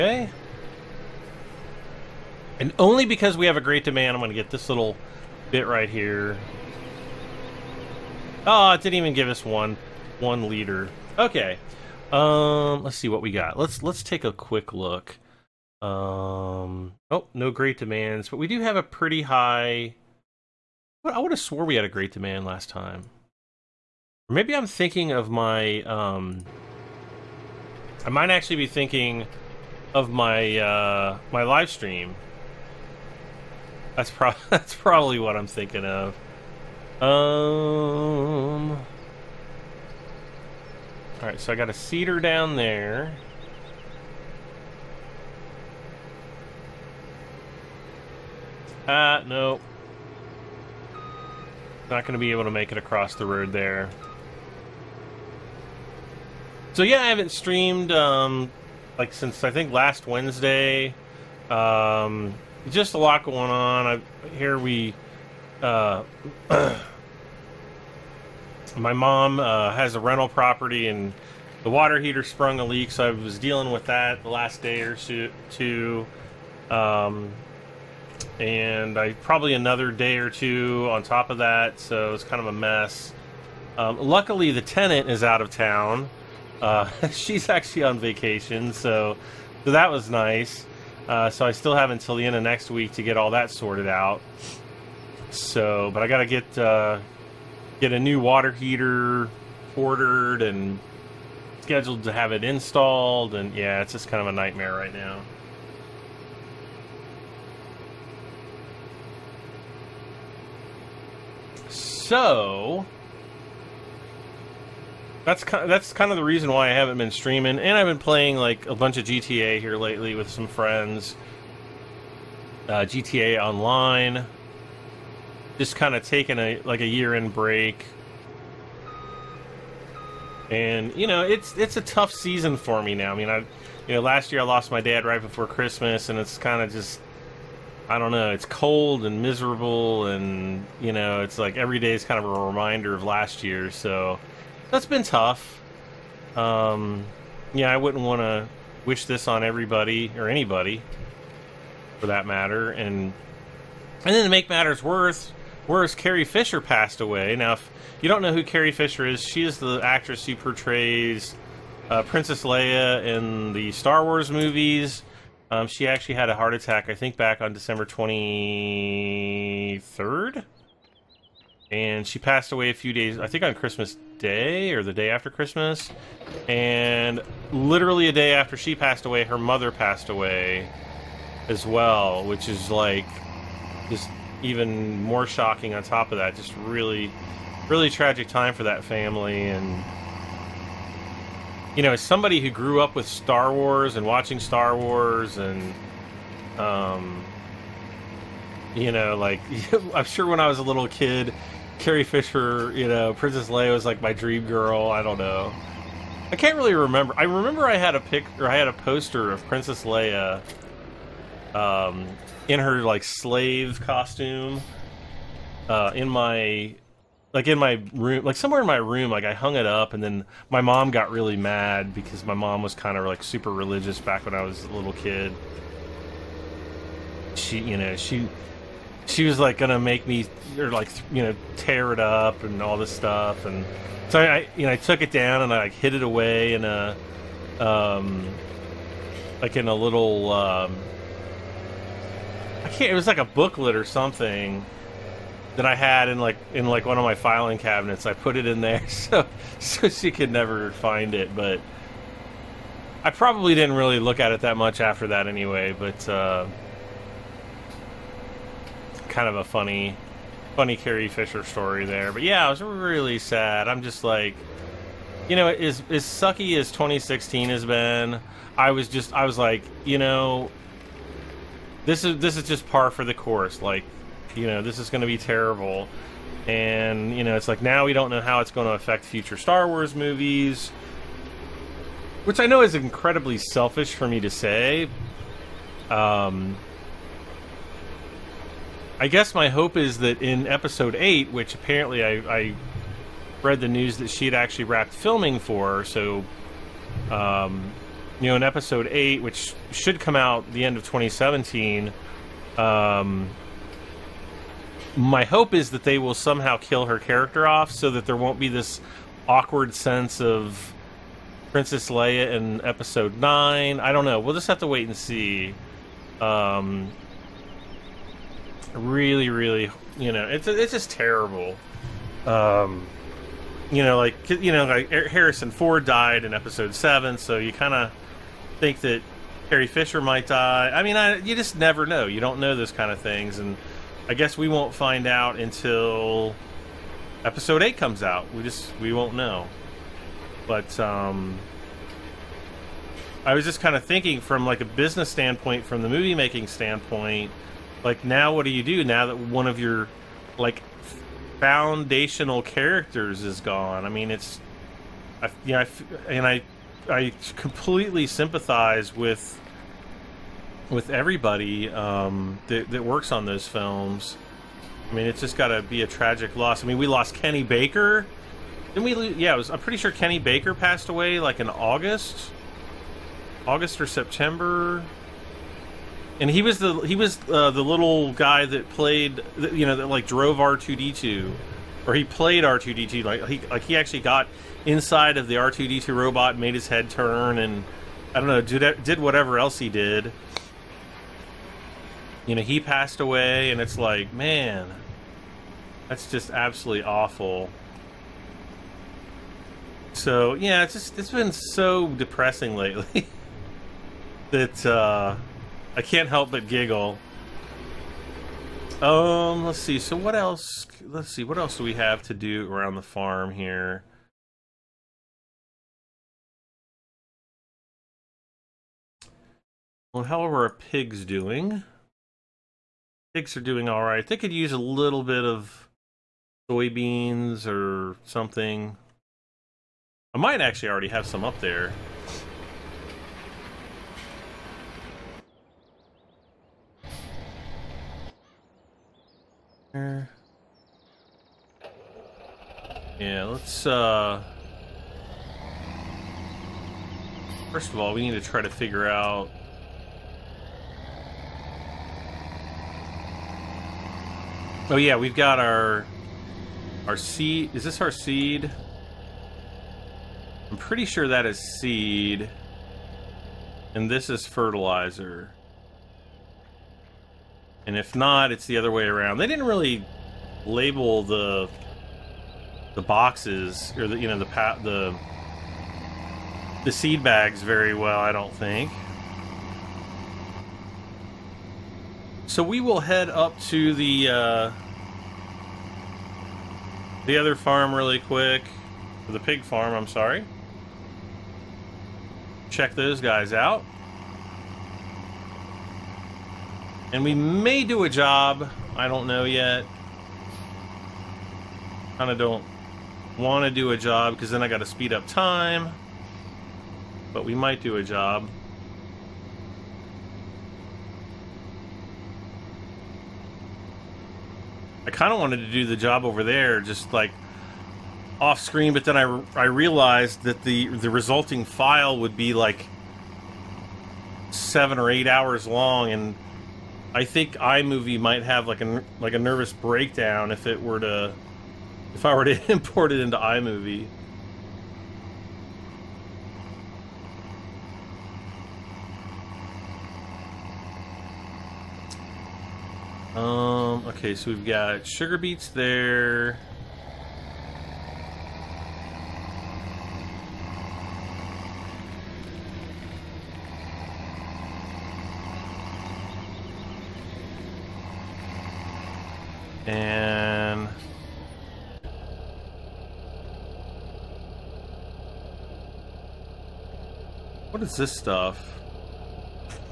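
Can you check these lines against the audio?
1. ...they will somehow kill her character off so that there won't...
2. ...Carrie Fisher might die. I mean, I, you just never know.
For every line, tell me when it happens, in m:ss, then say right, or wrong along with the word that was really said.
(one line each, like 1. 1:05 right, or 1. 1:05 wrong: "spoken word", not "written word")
1. 5:05 right
2. 5:29 right.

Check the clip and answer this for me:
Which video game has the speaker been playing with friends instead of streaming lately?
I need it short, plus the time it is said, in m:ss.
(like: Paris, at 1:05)
GTA Online, at 2:02.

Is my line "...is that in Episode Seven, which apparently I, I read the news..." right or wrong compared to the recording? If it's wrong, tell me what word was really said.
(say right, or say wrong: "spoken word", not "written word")
wrong: "Eight", not "Seven".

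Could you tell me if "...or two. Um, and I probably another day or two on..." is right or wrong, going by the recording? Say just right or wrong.
right.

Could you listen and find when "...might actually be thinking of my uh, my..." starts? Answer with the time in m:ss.
0:28.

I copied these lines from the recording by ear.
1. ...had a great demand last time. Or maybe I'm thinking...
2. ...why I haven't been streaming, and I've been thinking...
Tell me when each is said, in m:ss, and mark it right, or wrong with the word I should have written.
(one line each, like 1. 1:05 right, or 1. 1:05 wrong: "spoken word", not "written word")
1. 0:21 right
2. 1:56 wrong: "playing", not "thinking".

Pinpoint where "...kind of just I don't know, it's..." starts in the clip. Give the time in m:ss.
2:16.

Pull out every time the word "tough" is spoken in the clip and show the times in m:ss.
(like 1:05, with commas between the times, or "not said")
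2:11, 2:25.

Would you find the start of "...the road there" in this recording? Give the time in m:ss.
0:53.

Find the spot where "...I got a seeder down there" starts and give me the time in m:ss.
0:41.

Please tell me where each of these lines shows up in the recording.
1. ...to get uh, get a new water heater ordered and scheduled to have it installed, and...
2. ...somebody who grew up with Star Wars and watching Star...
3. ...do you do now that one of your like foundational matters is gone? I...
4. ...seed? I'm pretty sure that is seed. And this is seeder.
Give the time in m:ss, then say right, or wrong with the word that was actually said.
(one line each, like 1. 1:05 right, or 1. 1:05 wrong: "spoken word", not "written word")
1. 1:36 right
2. 3:12 right
3. 5:48 wrong: "characters", not "matters"
4. 7:37 wrong: "fertilizer", not "seeder".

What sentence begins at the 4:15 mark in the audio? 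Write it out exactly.
But uh, kind of a funny funny Carrie Fisher story there.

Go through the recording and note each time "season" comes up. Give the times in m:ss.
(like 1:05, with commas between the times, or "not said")
2:12.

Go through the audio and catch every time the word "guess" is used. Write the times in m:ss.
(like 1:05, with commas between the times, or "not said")
4:49, 5:34.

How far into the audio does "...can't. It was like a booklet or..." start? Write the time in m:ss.
4:02.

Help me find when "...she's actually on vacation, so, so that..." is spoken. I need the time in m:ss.
1:27.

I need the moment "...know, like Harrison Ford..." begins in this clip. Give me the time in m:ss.
5:24.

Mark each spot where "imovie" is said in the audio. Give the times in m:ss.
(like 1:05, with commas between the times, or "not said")
8:47, 8:53.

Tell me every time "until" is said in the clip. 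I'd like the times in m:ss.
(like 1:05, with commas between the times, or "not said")
1:31, 5:35.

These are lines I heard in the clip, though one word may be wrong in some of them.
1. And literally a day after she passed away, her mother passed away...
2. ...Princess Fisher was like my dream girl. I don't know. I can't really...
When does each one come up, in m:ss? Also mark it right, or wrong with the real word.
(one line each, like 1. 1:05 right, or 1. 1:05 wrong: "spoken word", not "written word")
1. 2:56 right
2. 3:23 wrong: "Leia", not "Fisher".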